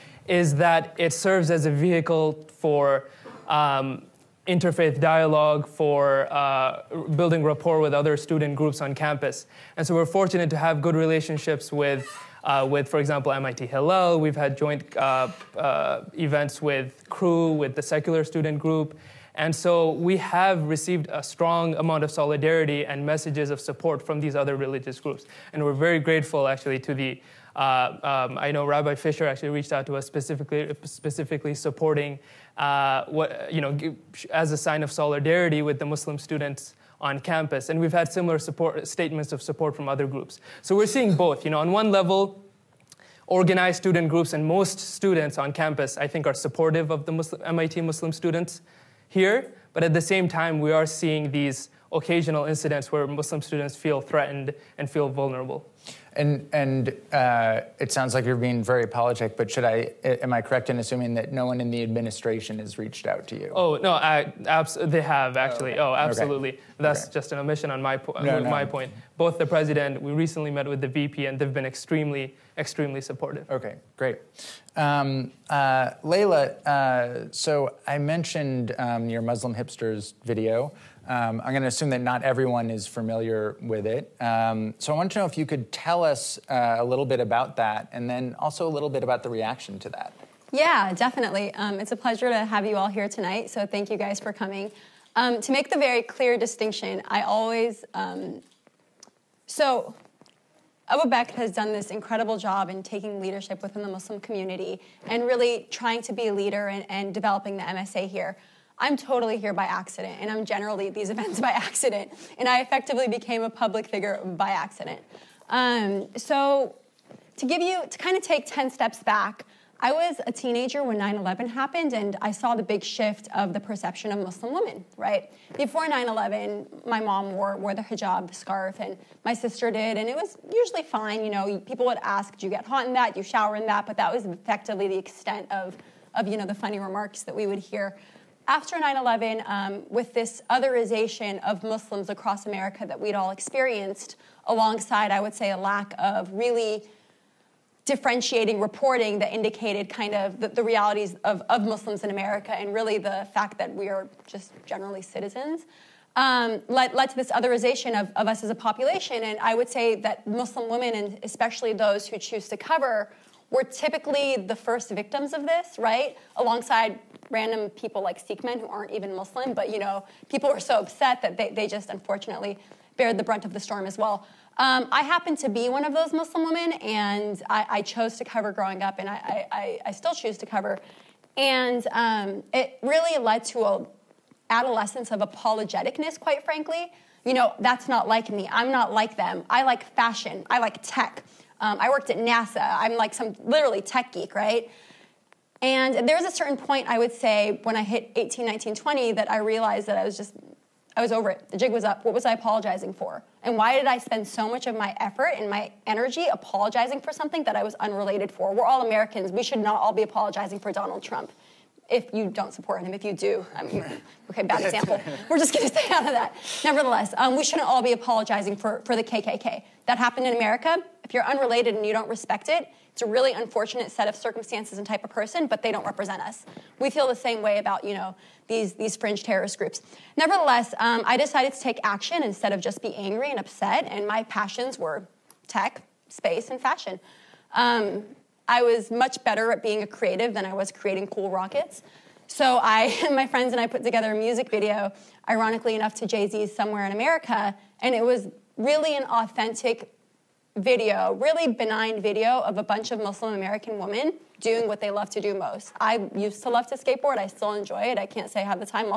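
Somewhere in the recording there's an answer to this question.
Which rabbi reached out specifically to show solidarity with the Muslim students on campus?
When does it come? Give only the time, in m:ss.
0:28.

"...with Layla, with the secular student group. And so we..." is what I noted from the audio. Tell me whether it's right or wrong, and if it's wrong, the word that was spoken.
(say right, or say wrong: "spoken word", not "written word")
wrong: "Cru", not "Layla".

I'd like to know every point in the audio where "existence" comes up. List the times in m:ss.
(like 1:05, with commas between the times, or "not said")
not said.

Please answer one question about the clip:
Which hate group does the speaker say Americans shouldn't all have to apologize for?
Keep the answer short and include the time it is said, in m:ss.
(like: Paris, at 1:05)
KKK, at 3:39.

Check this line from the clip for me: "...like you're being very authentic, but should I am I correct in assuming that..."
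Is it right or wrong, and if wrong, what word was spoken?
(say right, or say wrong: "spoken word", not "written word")
wrong: "apologetic", not "authentic".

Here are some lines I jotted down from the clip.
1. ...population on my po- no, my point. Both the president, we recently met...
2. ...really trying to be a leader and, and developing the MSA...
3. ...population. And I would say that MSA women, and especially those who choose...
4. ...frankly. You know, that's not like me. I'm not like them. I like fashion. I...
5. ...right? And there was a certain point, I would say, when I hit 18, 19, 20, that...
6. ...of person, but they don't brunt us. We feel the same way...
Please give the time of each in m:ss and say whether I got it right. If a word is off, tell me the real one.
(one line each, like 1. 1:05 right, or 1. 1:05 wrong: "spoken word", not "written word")
1. 1:07 wrong: "omission", not "population"
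2. 1:45 right
3. 2:38 wrong: "Muslim", not "MSA"
4. 3:06 right
5. 3:14 right
6. 3:45 wrong: "represent", not "brunt".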